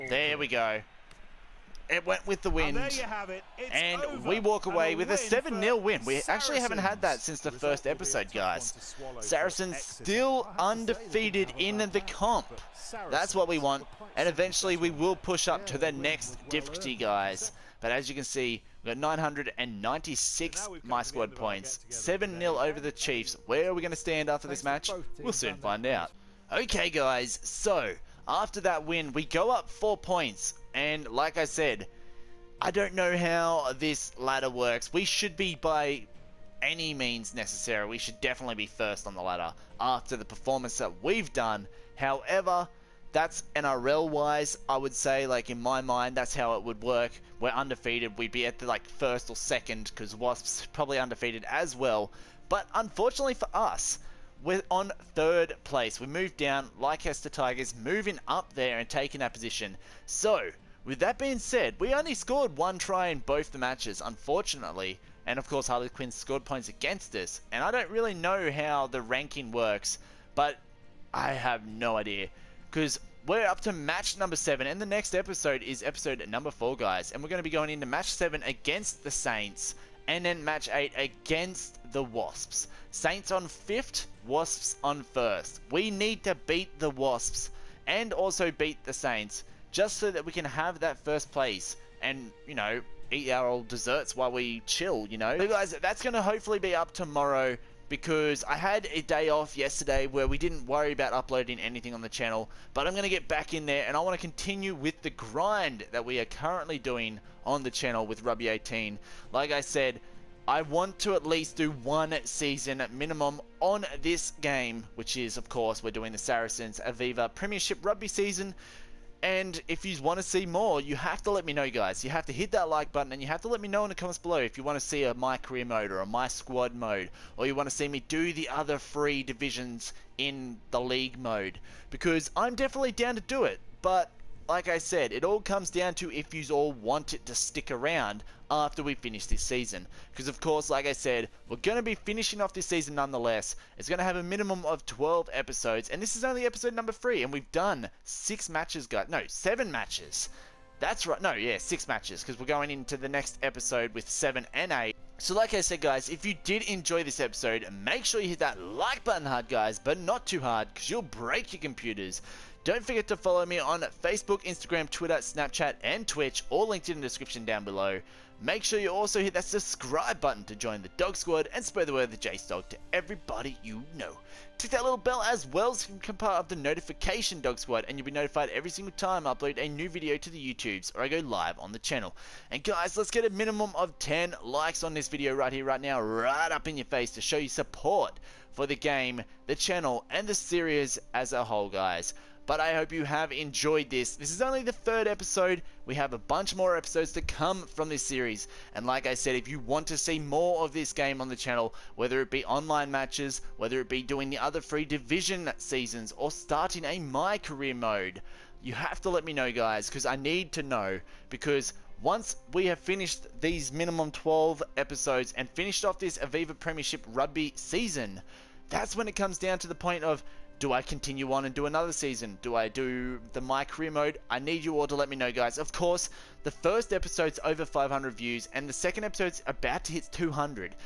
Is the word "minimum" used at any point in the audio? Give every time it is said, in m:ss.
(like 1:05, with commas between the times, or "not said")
1:52, 2:24, 3:03, 3:33.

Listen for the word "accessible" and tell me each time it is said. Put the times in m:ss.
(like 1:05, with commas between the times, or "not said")
not said.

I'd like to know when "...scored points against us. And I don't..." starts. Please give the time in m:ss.
1:06.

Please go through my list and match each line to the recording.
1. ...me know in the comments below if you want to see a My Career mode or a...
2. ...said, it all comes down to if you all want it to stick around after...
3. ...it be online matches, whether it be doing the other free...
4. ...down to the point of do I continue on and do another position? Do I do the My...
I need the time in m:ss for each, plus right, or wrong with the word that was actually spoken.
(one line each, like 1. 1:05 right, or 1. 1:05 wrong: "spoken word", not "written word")
1. 2:03 right
2. 2:14 right
3. 3:22 right
4. 3:39 wrong: "season", not "position".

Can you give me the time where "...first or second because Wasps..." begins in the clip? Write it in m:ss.
0:48.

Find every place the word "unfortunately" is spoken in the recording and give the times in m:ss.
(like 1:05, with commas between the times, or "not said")
0:52, 1:04.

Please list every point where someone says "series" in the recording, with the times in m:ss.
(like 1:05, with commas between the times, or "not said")
3:10, 3:18.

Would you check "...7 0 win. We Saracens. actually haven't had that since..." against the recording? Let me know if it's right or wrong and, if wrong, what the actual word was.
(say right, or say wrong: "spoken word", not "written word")
right.